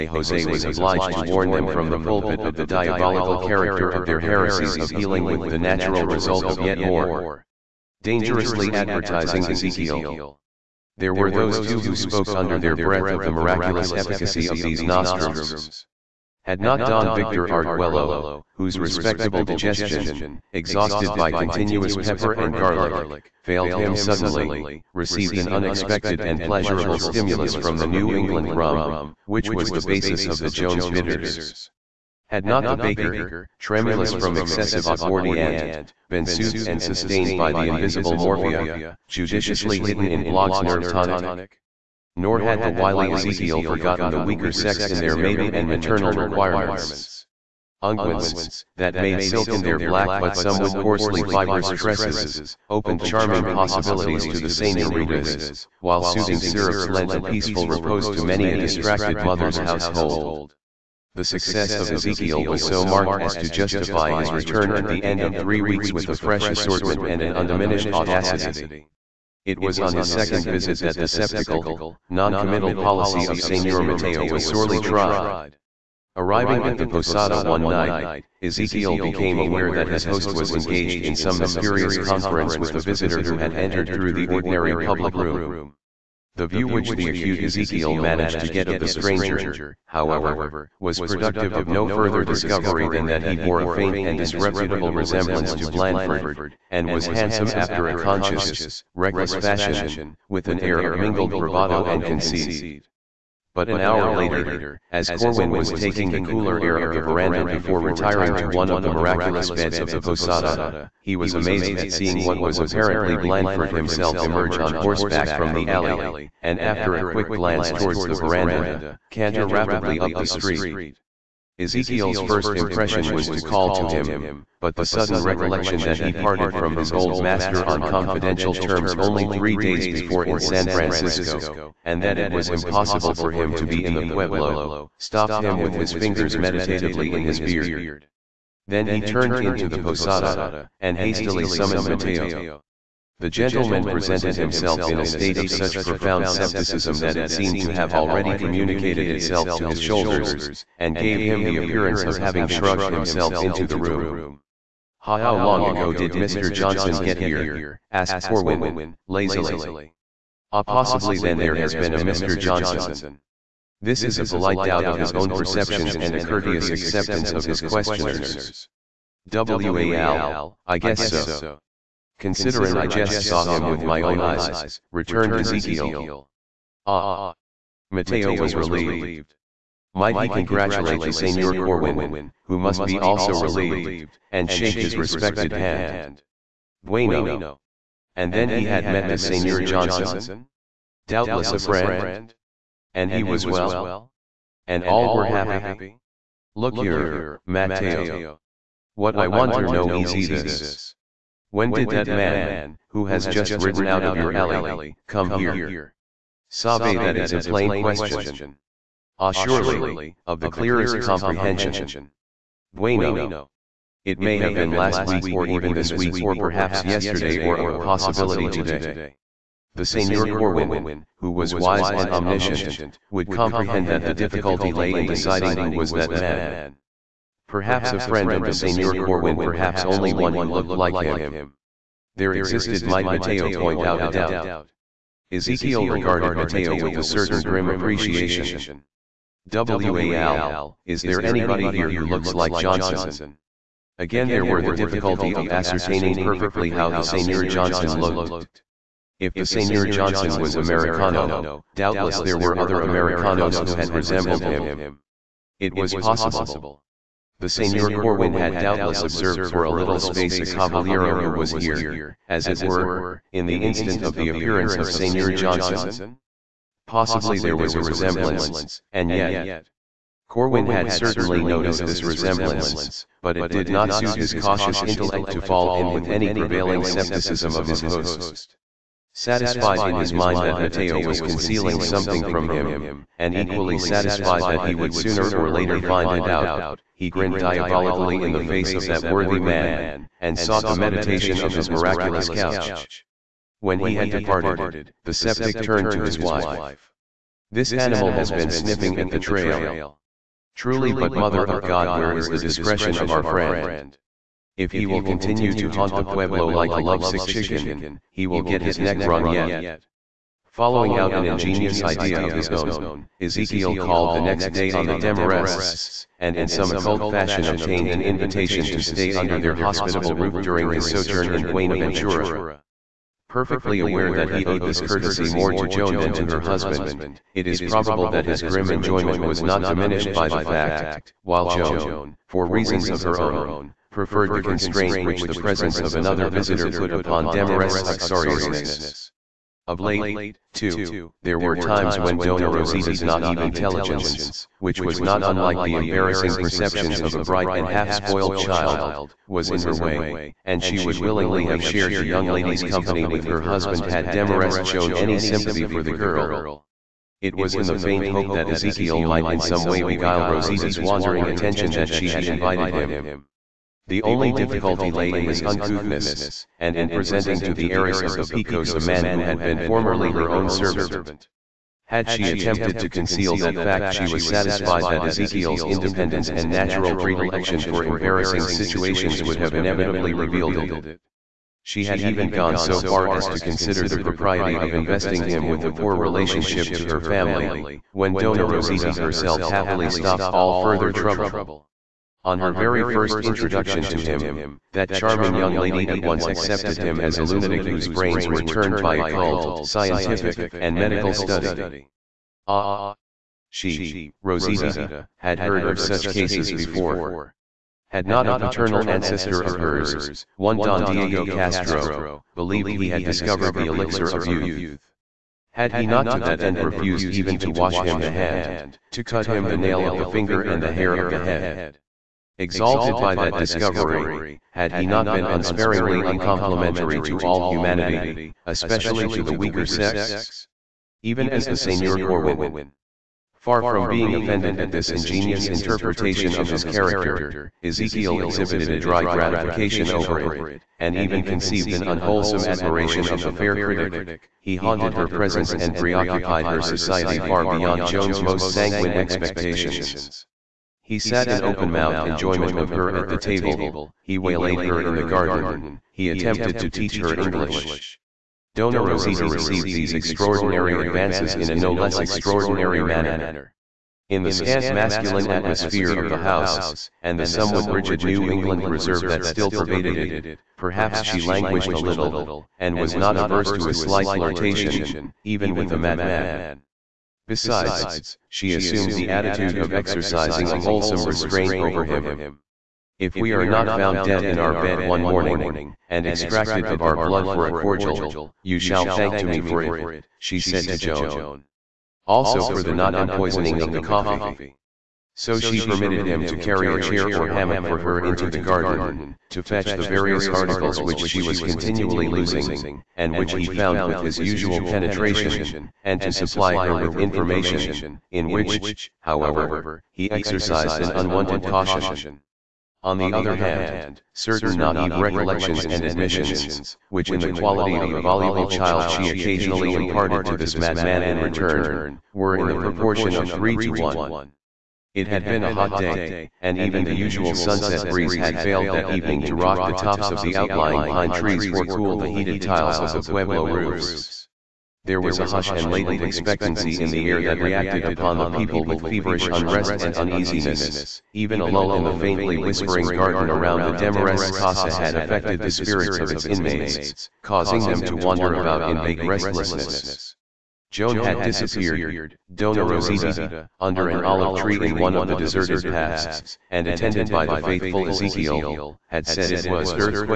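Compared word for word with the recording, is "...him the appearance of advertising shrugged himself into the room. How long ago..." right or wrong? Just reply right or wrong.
wrong.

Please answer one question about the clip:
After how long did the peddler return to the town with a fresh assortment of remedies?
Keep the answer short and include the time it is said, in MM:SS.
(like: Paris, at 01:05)
three weeks, at 01:05.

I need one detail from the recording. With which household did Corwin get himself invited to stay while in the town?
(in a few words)
the Demarests.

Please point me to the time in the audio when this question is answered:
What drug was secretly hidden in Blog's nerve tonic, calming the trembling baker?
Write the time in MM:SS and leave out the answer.
00:38.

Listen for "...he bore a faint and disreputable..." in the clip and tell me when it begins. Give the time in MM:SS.
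01:33.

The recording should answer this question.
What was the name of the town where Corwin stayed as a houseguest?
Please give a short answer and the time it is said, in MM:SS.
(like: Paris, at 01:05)
Buenaventura, at 05:21.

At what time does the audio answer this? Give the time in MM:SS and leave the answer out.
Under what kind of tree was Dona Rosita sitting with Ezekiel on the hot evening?
09:14.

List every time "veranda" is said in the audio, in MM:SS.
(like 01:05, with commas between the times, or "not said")
01:47, 01:58.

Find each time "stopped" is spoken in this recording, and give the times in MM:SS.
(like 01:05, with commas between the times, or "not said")
02:14, 06:29.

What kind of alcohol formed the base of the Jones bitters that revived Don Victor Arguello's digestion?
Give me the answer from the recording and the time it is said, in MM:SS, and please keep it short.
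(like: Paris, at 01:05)
New England rum, at 00:27.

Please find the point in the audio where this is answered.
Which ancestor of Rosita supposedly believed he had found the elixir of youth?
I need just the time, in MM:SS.
06:50.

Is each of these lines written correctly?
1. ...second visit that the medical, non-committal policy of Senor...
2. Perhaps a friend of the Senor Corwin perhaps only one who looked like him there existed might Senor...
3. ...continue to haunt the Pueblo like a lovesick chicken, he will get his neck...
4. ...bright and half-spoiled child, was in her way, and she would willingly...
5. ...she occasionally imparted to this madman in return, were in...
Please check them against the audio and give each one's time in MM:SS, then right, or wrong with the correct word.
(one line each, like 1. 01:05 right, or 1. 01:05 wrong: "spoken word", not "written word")
1. 01:10 wrong: "sceptical", not "medical"
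2. 03:47 wrong: "Mateo", not "Senor"
3. 05:05 right
4. 05:47 right
5. 08:38 right.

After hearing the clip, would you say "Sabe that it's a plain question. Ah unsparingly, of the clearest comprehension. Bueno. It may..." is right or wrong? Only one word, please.
wrong.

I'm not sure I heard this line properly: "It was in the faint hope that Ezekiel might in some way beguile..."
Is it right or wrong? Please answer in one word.
right.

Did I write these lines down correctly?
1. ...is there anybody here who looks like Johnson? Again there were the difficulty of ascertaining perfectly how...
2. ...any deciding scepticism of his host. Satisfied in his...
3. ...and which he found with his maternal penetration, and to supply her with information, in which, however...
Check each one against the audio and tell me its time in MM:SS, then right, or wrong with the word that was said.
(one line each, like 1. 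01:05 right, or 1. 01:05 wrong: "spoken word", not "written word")
1. 04:00 right
2. 04:36 wrong: "prevailing", not "deciding"
3. 08:22 wrong: "usual", not "maternal".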